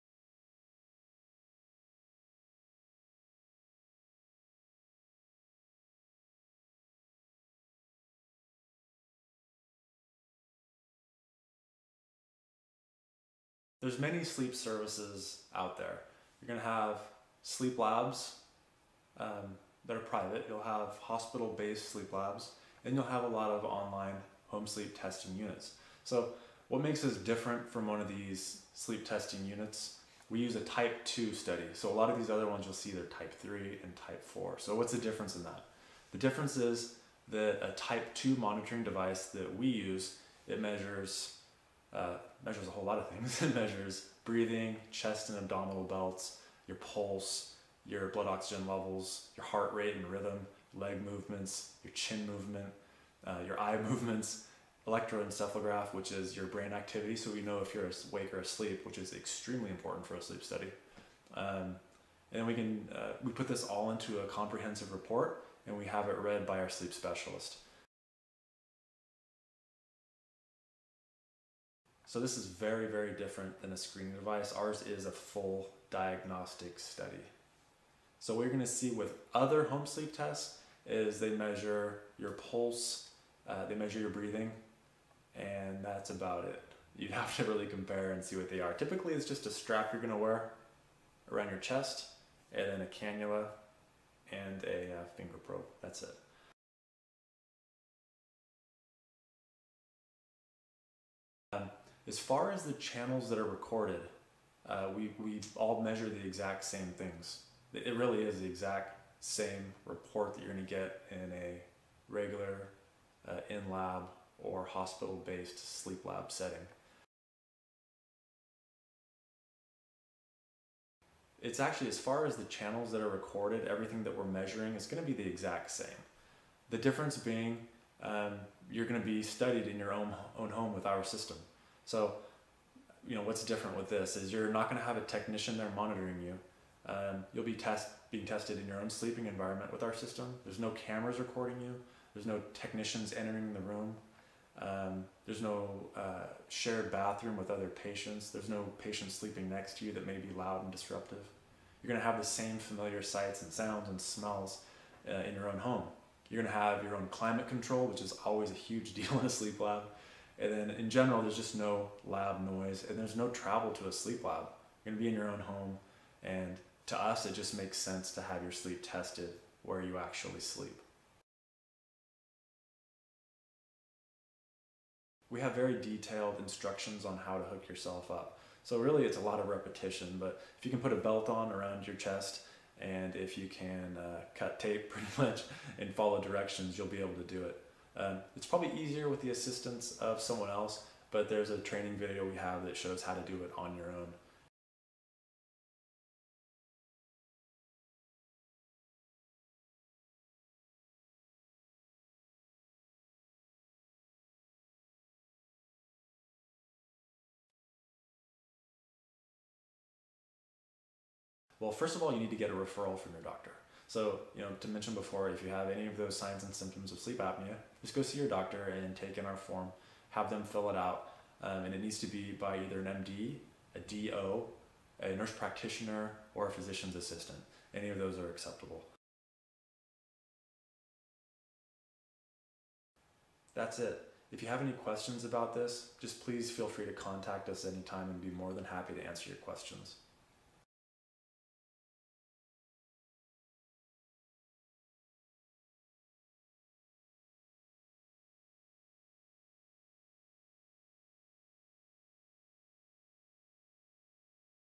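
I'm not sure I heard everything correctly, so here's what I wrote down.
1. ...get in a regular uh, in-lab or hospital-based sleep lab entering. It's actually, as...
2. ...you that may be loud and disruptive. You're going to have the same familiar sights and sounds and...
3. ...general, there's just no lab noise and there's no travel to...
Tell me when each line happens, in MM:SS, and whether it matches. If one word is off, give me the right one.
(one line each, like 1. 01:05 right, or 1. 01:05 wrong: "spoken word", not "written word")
1. 01:50 wrong: "setting", not "entering"
2. 02:29 right
3. 02:40 right.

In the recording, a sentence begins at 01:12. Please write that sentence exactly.
So this is very, very different than a screening device.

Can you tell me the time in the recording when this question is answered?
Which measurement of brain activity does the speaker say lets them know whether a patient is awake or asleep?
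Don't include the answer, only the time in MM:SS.
00:54.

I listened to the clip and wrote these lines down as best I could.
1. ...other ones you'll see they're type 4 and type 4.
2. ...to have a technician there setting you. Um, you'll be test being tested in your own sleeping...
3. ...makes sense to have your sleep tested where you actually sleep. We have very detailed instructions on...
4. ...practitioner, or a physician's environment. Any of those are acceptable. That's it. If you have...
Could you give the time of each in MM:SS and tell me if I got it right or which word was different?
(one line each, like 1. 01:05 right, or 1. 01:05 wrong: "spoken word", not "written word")
1. 00:32 wrong: "3", not "4"
2. 02:14 wrong: "monitoring", not "setting"
3. 02:47 right
4. 03:45 wrong: "assistant", not "environment".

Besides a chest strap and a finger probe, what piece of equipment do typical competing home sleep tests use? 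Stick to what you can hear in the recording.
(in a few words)
A cannula.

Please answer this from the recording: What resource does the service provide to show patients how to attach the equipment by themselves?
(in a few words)
A training video.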